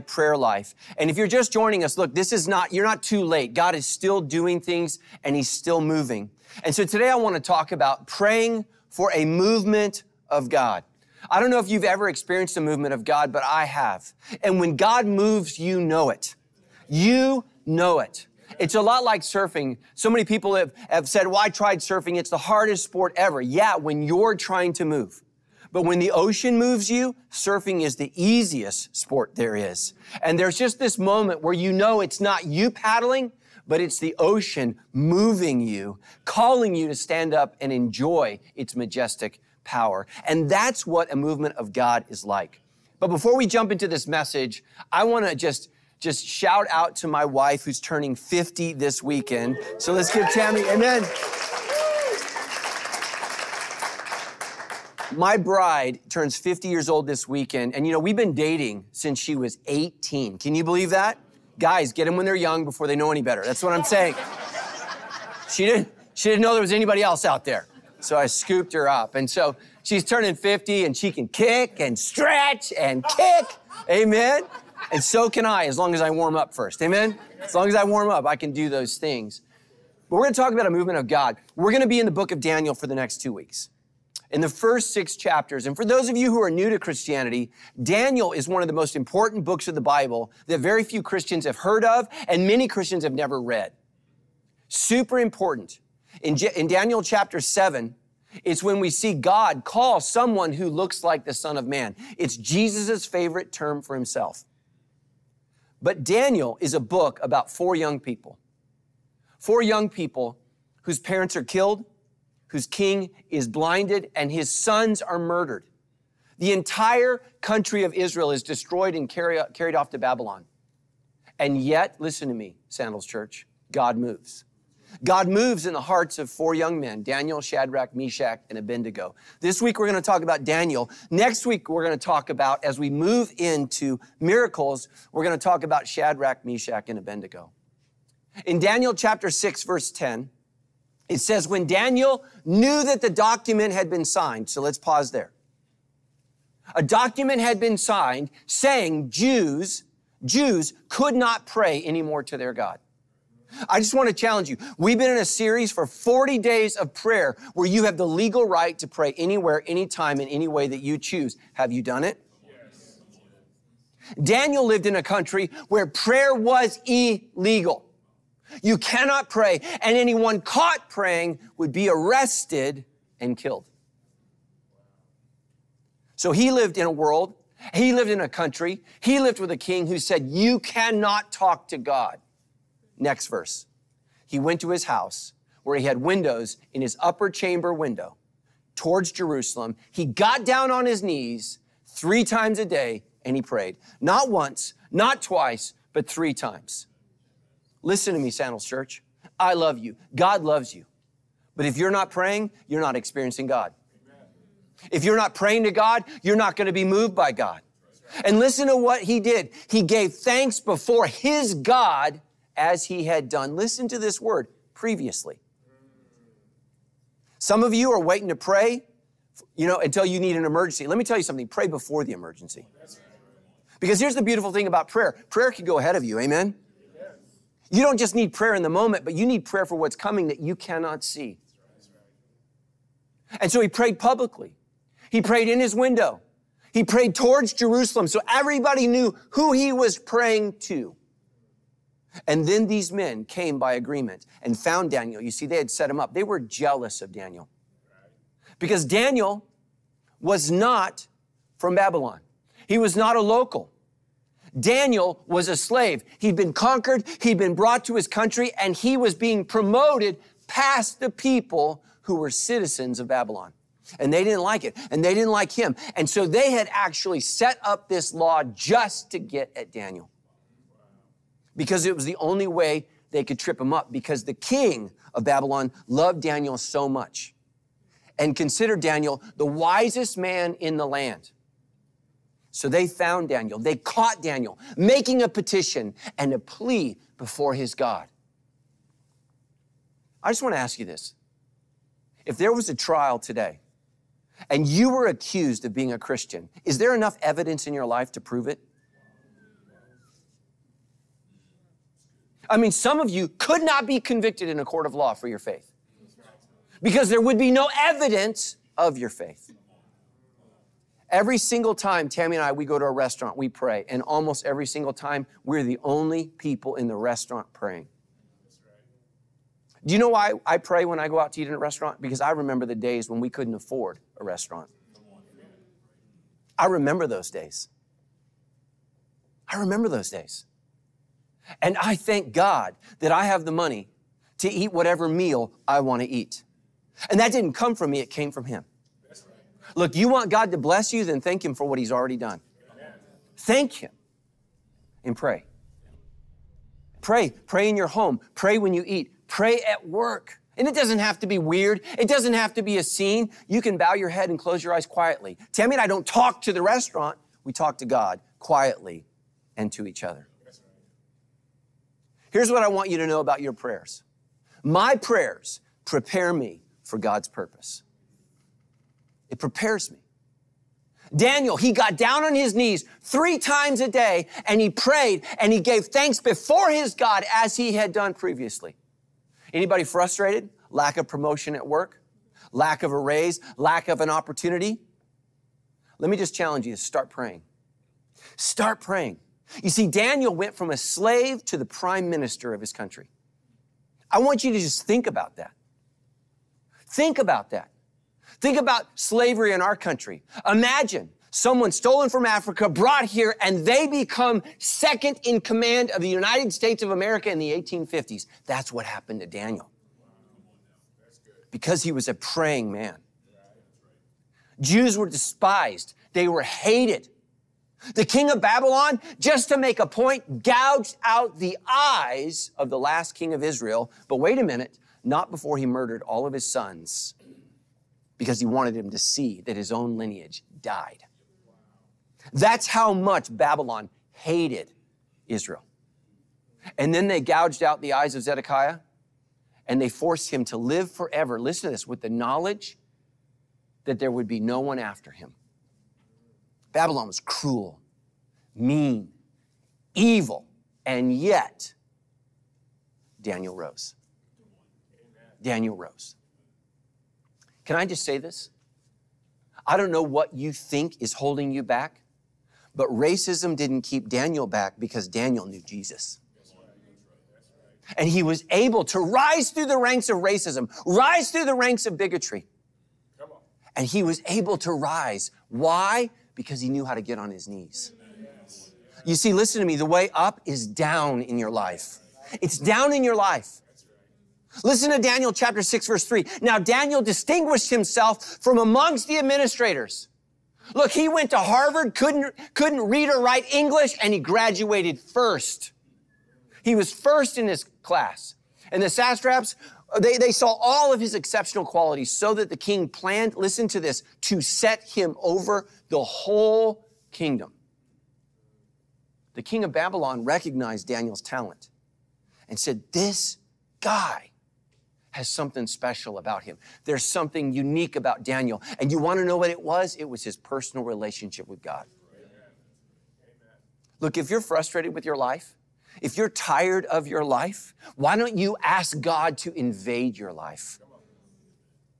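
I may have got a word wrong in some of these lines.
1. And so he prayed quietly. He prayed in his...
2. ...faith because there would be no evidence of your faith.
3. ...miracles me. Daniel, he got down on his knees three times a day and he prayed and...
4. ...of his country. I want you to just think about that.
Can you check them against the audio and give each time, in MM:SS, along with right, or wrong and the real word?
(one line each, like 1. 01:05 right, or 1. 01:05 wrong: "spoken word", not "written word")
1. 03:53 wrong: "publicly", not "quietly"
2. 05:05 right
3. 06:09 wrong: "prepares", not "miracles"
4. 06:32 right.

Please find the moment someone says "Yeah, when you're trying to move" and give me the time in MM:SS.
00:23.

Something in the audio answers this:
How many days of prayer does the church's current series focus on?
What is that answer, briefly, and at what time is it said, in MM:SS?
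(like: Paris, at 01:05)
40, at 02:35.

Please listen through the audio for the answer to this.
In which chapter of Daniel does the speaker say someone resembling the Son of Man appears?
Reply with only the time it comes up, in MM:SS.
01:37.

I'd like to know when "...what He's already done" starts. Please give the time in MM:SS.
05:41.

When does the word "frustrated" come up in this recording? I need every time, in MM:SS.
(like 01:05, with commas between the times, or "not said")
06:19, 08:44.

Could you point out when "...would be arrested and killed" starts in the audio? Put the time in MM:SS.
02:51.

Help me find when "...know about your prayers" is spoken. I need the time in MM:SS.
06:03.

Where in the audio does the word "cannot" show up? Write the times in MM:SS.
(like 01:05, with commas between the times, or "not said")
02:48, 03:00, 03:50.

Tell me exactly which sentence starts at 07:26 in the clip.
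Babylon was cruel, mean, evil, and yet Daniel rose.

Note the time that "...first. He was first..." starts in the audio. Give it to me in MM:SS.
08:14.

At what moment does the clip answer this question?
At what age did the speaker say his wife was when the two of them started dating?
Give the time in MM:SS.
00:59.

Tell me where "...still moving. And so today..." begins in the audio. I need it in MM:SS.
00:05.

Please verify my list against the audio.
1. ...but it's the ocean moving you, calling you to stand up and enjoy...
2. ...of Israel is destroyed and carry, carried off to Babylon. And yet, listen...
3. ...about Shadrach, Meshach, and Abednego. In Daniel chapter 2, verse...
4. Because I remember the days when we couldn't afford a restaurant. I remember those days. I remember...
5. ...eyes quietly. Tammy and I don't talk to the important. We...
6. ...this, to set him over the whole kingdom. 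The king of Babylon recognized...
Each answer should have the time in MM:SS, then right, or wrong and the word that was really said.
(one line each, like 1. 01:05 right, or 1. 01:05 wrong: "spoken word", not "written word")
1. 00:33 right
2. 01:57 right
3. 02:15 wrong: "6", not "2"
4. 05:22 right
5. 05:54 wrong: "restaurant", not "important"
6. 08:23 right.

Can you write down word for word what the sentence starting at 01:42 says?
It's Jesus' favorite term for himself.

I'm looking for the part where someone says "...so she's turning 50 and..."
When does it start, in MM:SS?
01:09.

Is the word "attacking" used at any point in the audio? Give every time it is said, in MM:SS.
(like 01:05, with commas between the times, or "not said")
not said.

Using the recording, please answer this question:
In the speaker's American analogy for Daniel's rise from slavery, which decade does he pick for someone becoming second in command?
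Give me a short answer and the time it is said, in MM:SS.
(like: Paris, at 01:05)
1850s, at 06:47.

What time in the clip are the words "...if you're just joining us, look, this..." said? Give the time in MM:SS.
00:01.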